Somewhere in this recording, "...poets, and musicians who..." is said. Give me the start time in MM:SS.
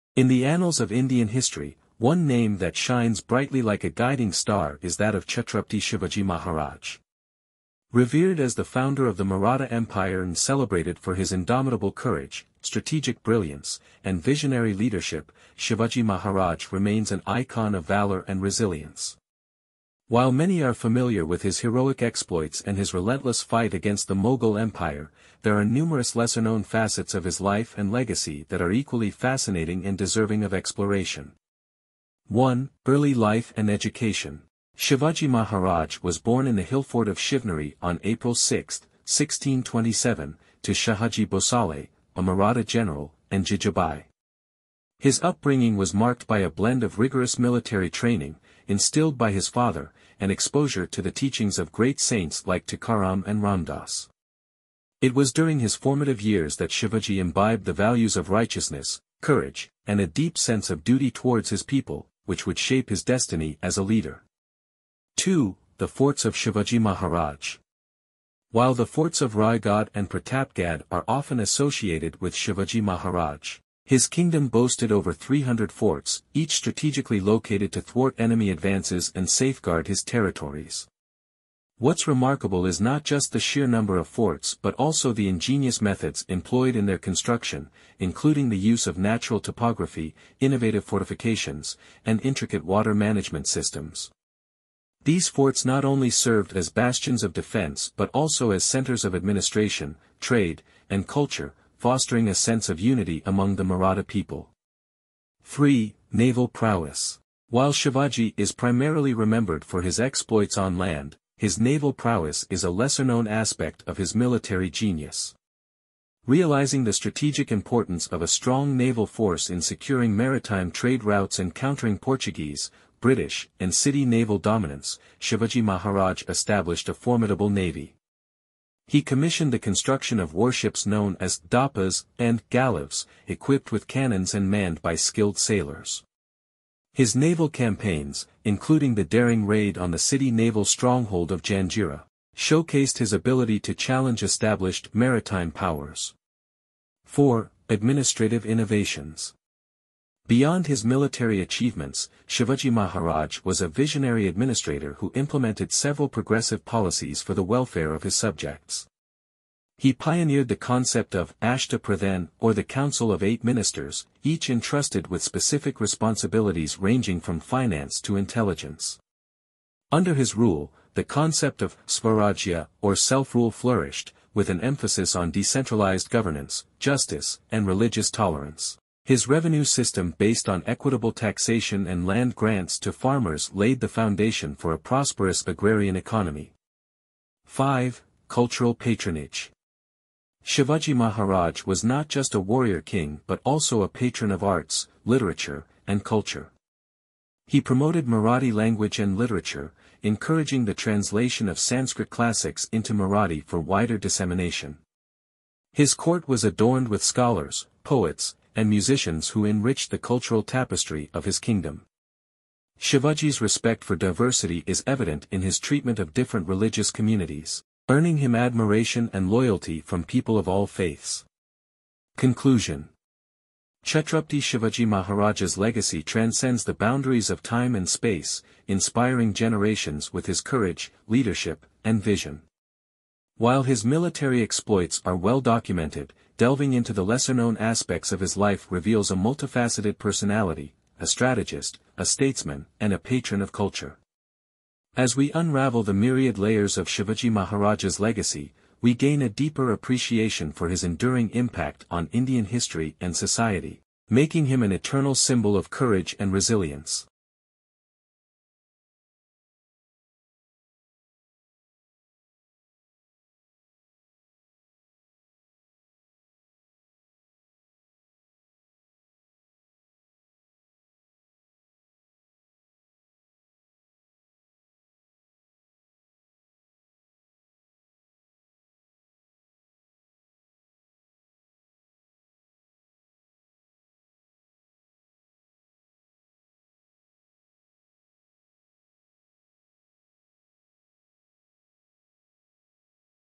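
03:27.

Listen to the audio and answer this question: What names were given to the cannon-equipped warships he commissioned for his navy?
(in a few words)
dapas and gallives.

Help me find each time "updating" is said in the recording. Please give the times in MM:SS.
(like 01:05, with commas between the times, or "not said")
not said.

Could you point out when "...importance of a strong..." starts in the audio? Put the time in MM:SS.
01:57.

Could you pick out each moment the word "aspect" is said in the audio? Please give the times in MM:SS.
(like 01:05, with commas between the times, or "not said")
01:53, 03:57.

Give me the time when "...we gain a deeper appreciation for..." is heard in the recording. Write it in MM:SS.
04:08.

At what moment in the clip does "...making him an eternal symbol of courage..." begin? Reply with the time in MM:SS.
04:14.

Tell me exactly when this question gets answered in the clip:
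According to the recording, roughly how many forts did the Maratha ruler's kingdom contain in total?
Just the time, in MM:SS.
01:14.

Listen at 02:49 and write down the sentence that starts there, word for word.
Under his rule, the concept of Swarajya or self-rule flourished, with an emphasis on decentralized governance, justice, and religious tolerance.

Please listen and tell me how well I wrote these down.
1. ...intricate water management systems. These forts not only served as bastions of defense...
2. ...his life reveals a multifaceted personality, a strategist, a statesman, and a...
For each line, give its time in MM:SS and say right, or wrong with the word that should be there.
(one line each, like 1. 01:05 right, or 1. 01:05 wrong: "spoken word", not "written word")
1. 01:32 right
2. 03:58 right.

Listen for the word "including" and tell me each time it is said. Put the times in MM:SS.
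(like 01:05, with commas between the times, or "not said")
01:27, 02:18.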